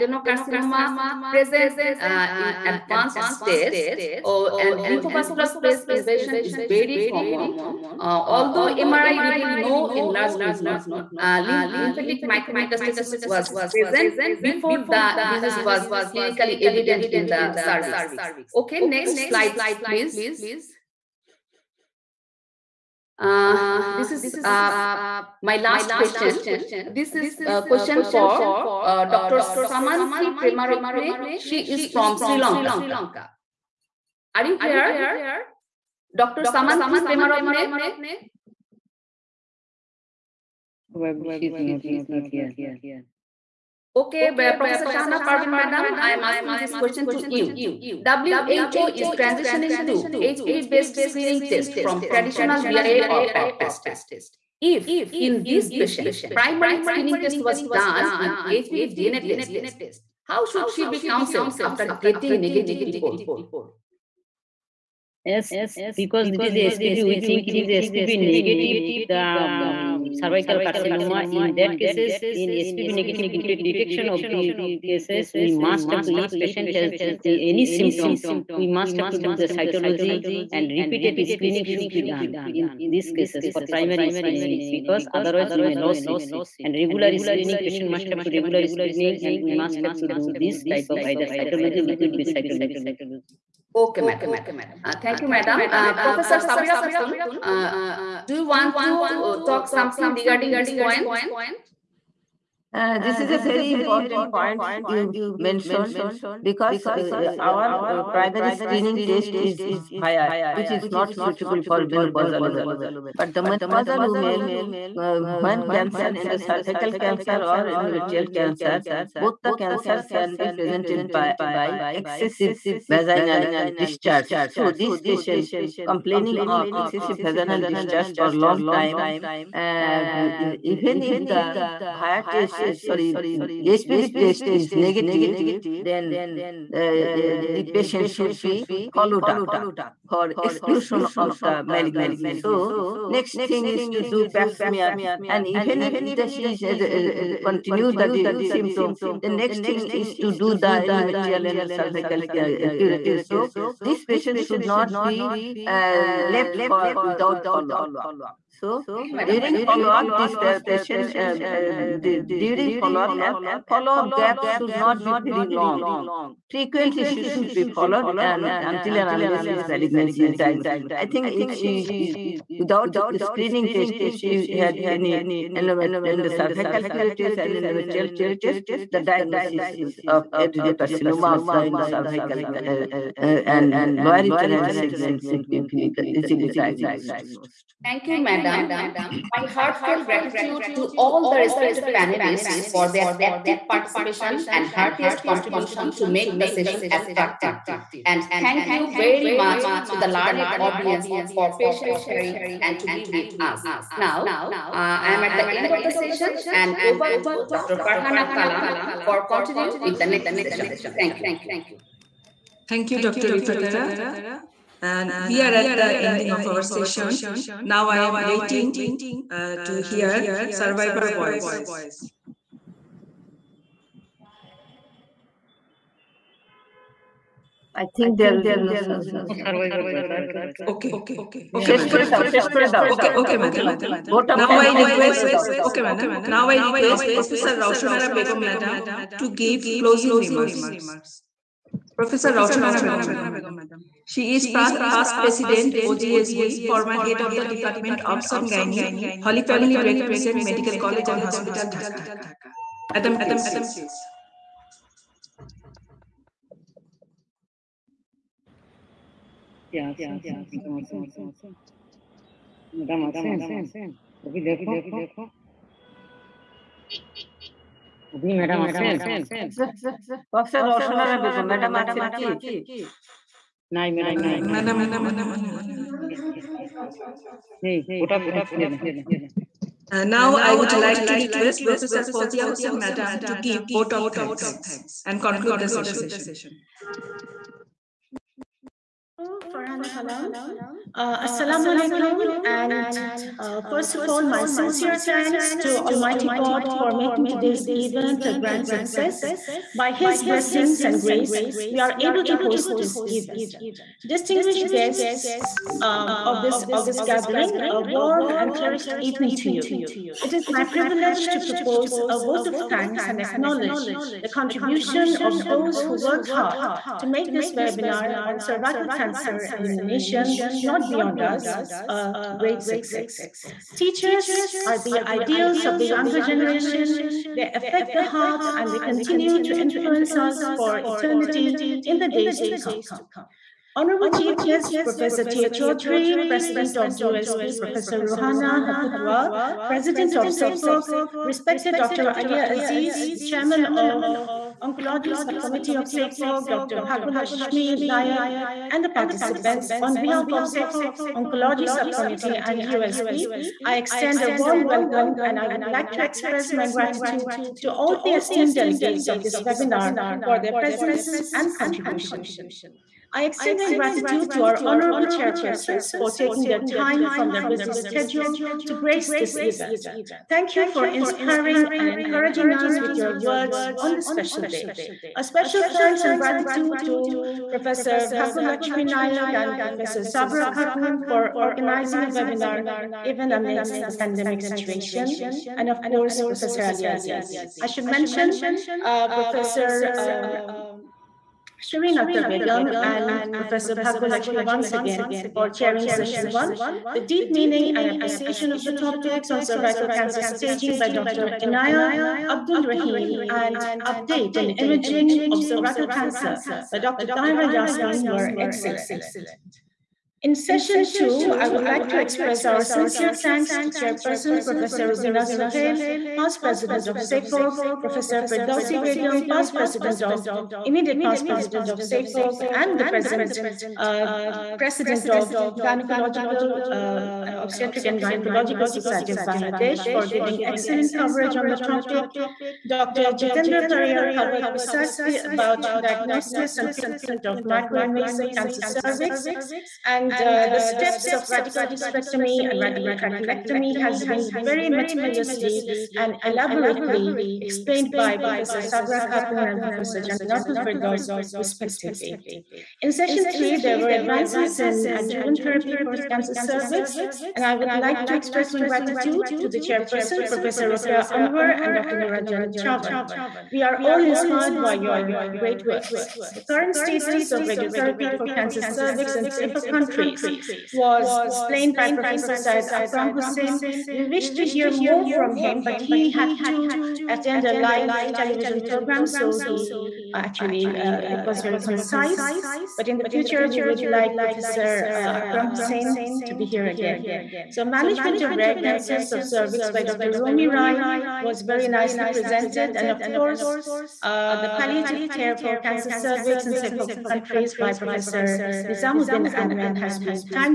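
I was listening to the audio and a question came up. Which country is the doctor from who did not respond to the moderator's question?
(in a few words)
Sri Lanka.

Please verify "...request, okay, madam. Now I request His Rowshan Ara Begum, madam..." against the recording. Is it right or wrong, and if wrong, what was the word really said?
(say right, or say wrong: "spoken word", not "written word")
wrong: "Professor", not "His".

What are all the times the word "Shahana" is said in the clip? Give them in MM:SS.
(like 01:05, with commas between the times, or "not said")
00:44.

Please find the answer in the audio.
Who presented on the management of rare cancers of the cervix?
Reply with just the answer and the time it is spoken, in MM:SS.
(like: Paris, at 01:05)
Romi Rai, at 08:09.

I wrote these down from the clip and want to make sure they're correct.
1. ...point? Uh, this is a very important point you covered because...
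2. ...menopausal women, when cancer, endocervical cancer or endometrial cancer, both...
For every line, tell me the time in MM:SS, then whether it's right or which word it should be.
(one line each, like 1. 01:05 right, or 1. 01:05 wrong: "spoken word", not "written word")
1. 01:40 wrong: "mentioned", not "covered"
2. 01:53 right.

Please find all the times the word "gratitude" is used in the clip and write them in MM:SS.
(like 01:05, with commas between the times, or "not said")
03:10, 05:56, 06:03, 06:16, 07:38.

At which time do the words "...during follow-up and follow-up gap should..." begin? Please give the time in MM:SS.
02:42.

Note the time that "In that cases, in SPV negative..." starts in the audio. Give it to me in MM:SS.
01:11.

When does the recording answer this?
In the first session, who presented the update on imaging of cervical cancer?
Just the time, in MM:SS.
06:46.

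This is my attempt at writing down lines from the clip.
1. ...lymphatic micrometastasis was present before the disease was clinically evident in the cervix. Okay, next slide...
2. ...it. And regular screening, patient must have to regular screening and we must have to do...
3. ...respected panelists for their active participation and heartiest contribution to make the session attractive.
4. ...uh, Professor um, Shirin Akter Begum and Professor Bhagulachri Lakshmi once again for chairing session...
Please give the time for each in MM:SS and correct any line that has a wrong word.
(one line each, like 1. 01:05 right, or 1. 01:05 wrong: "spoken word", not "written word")
1. 00:11 right
2. 01:26 right
3. 03:11 right
4. 06:28 right.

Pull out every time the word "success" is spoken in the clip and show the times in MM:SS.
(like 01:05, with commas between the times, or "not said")
04:58, 05:22.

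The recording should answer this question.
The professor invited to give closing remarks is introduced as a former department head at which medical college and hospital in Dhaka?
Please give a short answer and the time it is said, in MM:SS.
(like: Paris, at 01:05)
Holy Family Red Crescent Medical College, at 04:09.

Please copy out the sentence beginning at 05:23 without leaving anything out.
Teachers are the ideals of the younger generation.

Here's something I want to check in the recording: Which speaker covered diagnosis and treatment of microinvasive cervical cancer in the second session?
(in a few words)
Jitendra Pariyar.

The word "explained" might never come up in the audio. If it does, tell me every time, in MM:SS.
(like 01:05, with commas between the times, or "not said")
07:27, 07:51.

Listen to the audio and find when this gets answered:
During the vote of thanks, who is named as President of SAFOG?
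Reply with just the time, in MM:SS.
05:37.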